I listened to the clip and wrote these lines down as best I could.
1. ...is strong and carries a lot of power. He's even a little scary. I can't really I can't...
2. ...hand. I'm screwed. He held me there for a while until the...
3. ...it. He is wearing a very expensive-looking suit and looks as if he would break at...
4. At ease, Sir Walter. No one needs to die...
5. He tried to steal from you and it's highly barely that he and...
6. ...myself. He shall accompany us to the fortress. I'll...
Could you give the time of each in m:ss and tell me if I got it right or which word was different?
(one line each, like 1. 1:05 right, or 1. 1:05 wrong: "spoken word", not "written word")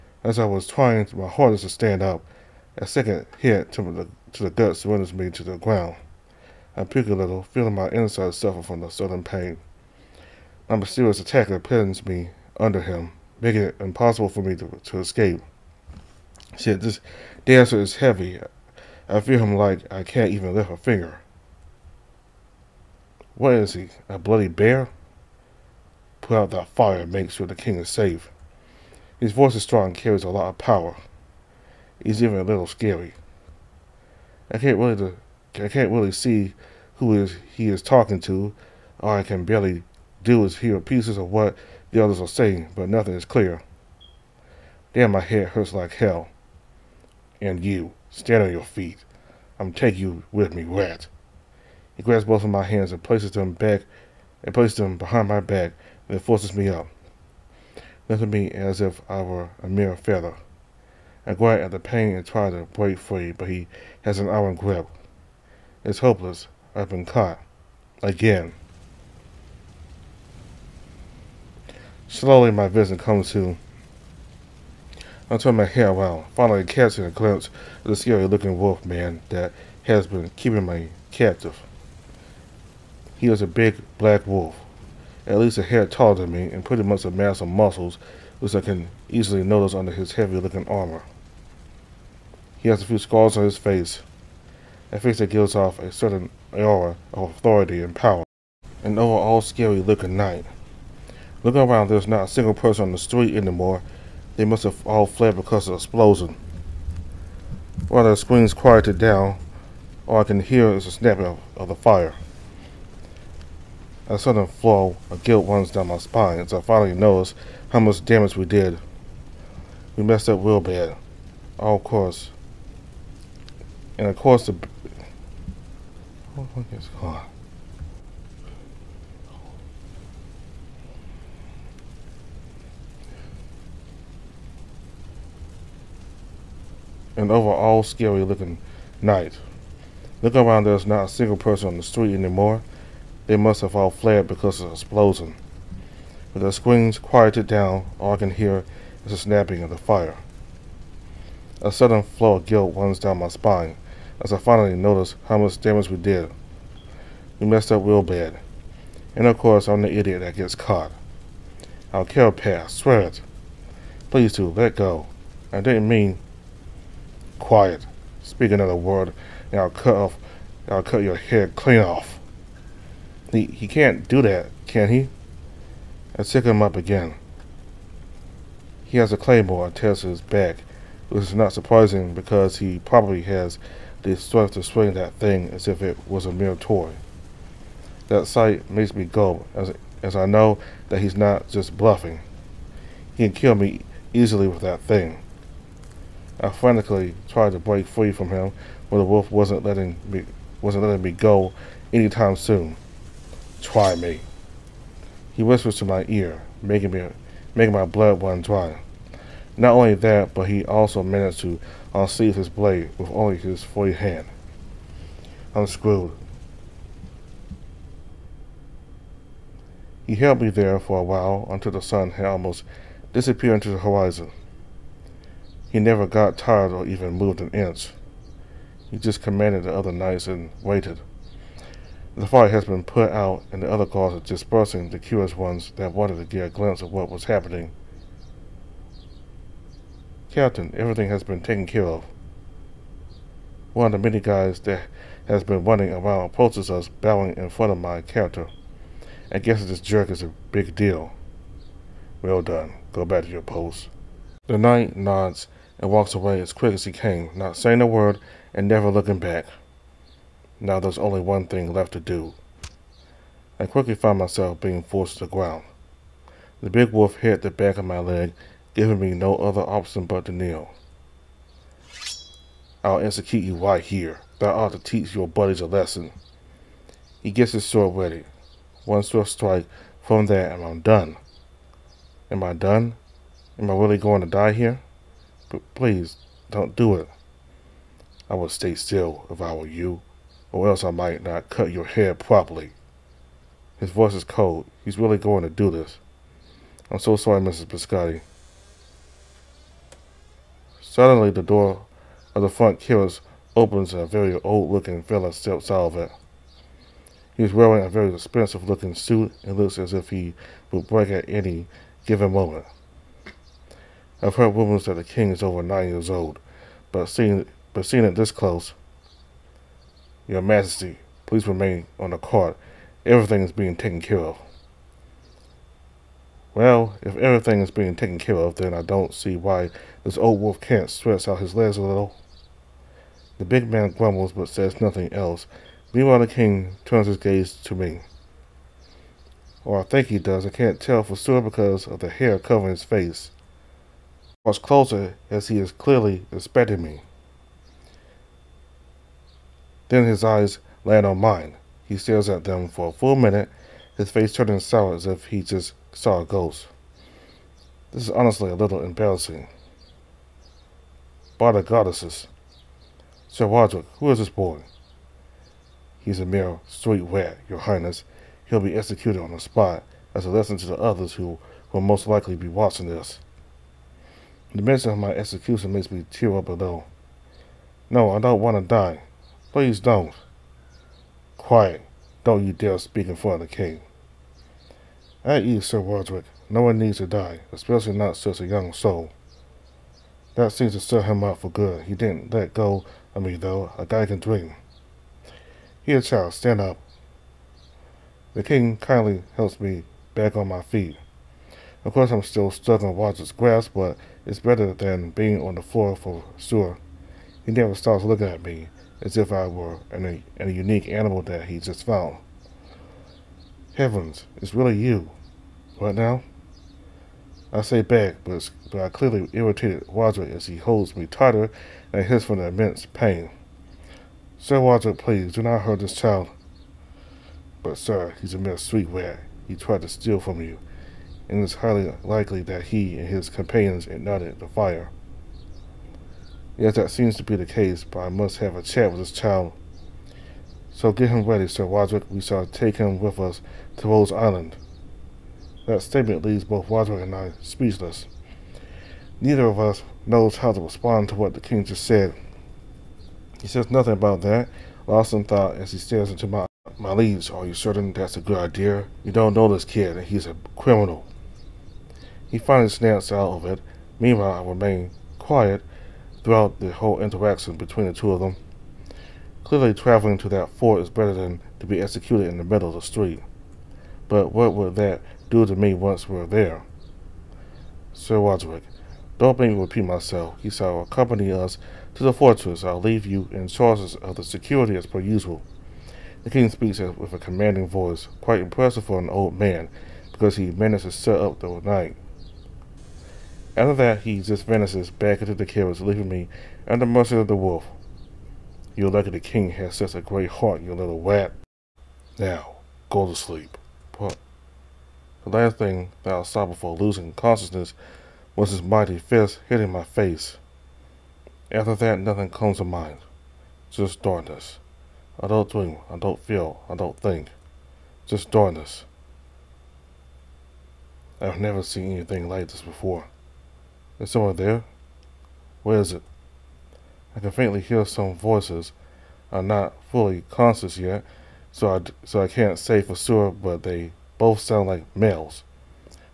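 1. 0:29 right
2. 3:33 right
3. 5:05 right
4. 6:25 wrong: "Roderick", not "Walter"
5. 7:09 wrong: "likely", not "barely"
6. 7:59 right.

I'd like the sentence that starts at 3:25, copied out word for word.
He whispers to my ear, making me making my blood run dry.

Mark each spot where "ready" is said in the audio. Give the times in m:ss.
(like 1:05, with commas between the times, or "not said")
4:37, 7:21.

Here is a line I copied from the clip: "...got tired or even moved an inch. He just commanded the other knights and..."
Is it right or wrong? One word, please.
right.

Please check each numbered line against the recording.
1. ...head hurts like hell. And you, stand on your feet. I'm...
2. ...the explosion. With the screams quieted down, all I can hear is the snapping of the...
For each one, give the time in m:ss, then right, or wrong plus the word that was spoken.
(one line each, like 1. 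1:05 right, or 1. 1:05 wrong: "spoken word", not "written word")
1. 0:45 right
2. 2:24 right.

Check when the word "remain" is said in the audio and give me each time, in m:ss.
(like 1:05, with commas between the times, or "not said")
5:21, 7:44.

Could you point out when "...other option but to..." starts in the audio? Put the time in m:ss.
4:29.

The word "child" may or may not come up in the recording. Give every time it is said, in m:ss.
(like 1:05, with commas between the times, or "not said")
6:35, 7:05, 7:19.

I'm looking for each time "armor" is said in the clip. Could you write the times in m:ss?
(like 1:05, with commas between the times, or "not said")
1:30.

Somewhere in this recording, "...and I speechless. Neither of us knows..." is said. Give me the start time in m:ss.
7:27.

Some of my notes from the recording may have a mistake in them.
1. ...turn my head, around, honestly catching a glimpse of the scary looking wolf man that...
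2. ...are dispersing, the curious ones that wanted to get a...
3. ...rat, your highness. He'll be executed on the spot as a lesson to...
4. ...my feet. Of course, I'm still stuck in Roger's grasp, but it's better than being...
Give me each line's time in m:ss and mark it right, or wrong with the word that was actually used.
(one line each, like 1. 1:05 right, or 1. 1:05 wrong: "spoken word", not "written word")
1. 1:15 wrong: "finally", not "honestly"
2. 3:54 right
3. 6:07 right
4. 6:40 right.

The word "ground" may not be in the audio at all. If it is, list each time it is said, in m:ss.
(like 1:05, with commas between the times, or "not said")
0:05, 4:25.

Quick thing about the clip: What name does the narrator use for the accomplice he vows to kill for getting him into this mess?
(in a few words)
Pat.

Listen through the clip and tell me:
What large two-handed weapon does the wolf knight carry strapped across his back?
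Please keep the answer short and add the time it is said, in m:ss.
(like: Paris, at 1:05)
claymore, at 2:59.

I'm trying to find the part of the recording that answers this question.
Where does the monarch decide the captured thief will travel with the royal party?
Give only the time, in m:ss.
7:23.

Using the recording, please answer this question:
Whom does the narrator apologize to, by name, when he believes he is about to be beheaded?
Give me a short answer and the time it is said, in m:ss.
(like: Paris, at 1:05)
Mrs. Biscotti, at 4:57.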